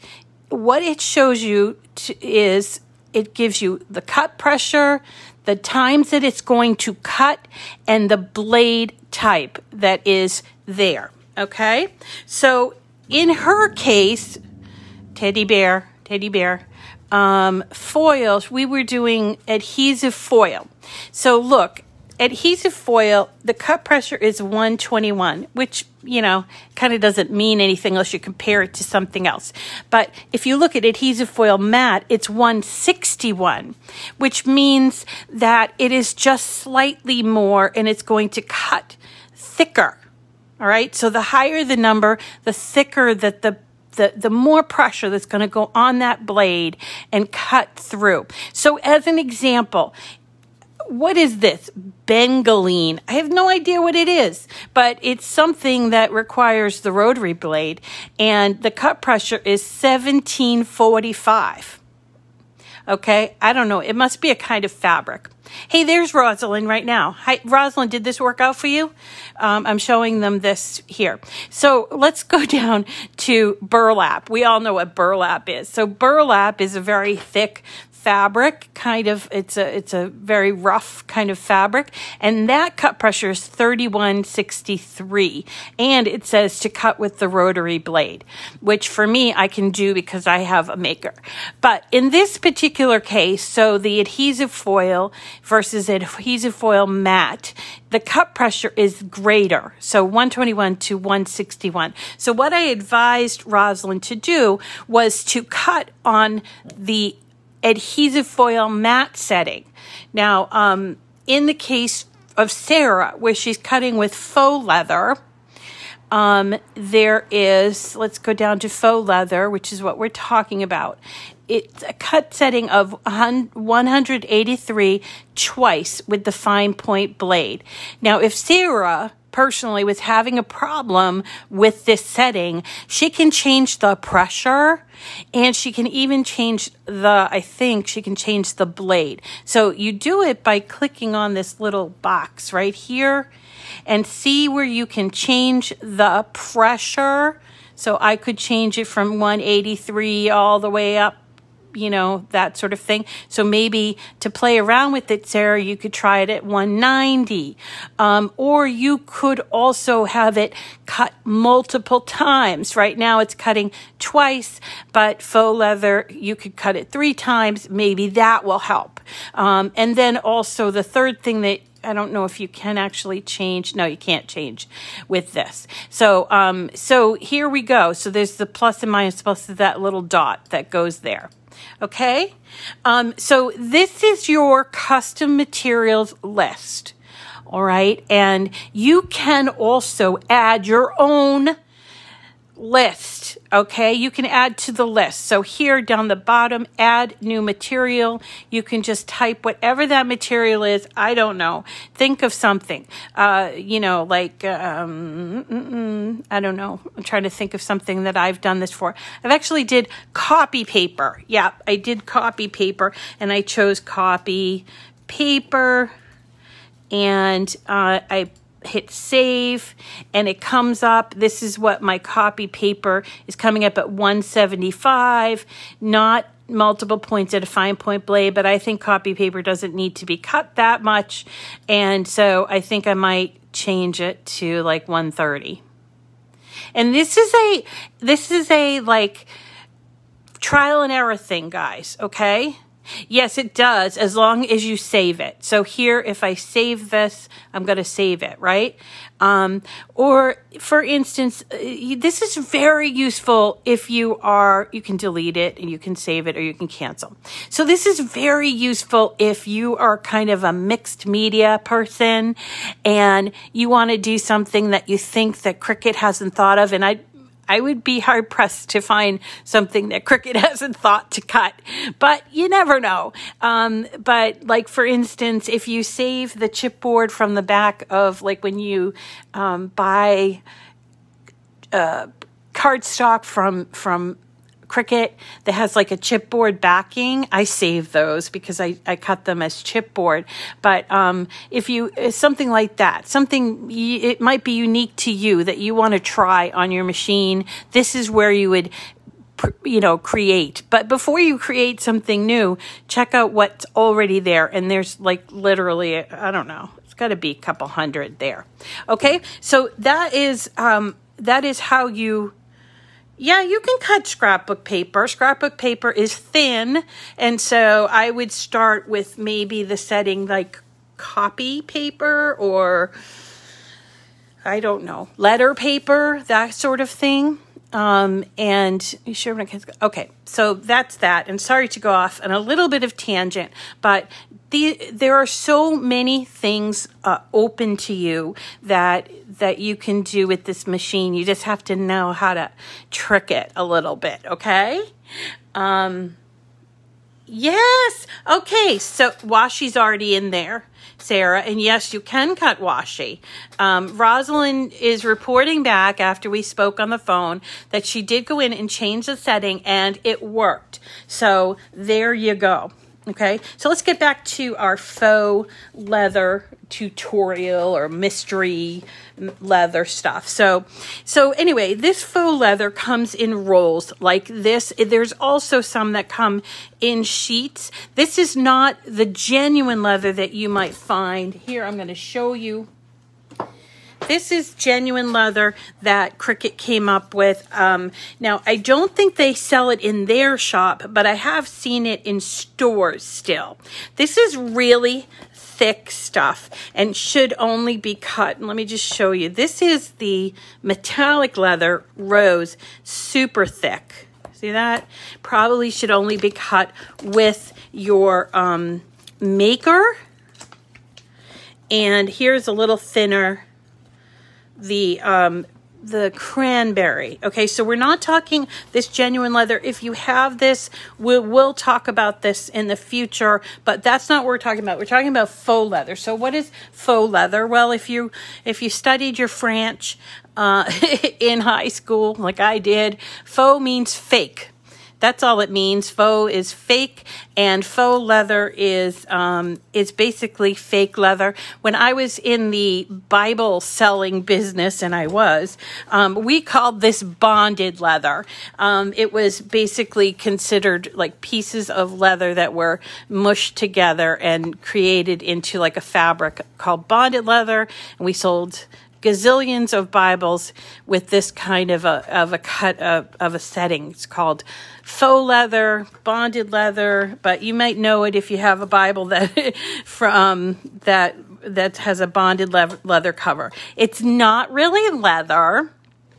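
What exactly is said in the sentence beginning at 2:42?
Right now it's cutting twice, but faux leather, you could cut it three times.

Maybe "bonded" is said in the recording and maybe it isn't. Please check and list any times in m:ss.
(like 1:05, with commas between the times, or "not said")
7:27, 7:36, 7:46, 7:52.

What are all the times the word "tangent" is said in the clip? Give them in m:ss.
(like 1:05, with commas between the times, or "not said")
5:32.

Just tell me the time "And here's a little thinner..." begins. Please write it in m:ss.
6:51.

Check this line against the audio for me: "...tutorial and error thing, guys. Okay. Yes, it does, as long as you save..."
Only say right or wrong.
wrong.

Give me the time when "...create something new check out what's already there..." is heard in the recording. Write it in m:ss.
5:01.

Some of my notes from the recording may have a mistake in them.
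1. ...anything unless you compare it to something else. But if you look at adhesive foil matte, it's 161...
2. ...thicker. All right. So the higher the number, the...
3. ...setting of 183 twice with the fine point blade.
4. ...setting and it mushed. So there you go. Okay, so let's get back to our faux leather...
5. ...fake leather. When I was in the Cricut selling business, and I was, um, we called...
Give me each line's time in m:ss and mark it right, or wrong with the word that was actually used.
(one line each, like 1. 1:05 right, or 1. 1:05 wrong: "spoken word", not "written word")
1. 0:27 right
2. 0:39 right
3. 2:02 right
4. 5:59 wrong: "worked", not "mushed"
5. 7:20 wrong: "Bible", not "Cricut".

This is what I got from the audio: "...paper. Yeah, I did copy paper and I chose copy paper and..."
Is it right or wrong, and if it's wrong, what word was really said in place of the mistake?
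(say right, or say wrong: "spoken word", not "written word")
right.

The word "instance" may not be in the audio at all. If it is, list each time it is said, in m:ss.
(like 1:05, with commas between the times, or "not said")
4:10, 4:34.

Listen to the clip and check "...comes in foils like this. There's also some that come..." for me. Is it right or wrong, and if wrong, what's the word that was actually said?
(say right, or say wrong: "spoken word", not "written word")
wrong: "rolls", not "foils".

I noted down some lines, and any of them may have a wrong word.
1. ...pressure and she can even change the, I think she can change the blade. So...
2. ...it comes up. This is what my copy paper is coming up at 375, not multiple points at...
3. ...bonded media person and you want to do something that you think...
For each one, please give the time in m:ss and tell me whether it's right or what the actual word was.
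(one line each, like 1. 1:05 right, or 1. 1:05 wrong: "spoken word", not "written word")
1. 2:13 right
2. 3:40 wrong: "175", not "375"
3. 4:20 wrong: "mixed", not "bonded".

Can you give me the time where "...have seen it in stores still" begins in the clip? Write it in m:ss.
6:31.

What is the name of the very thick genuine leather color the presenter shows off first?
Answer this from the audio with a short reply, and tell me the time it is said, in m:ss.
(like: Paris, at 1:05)
Metallic leather rose, at 6:40.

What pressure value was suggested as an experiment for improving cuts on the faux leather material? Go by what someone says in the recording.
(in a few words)
190.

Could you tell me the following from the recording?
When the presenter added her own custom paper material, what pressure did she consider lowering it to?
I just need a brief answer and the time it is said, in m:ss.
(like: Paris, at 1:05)
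130, at 3:54.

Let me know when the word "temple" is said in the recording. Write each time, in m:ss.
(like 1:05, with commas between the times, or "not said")
not said.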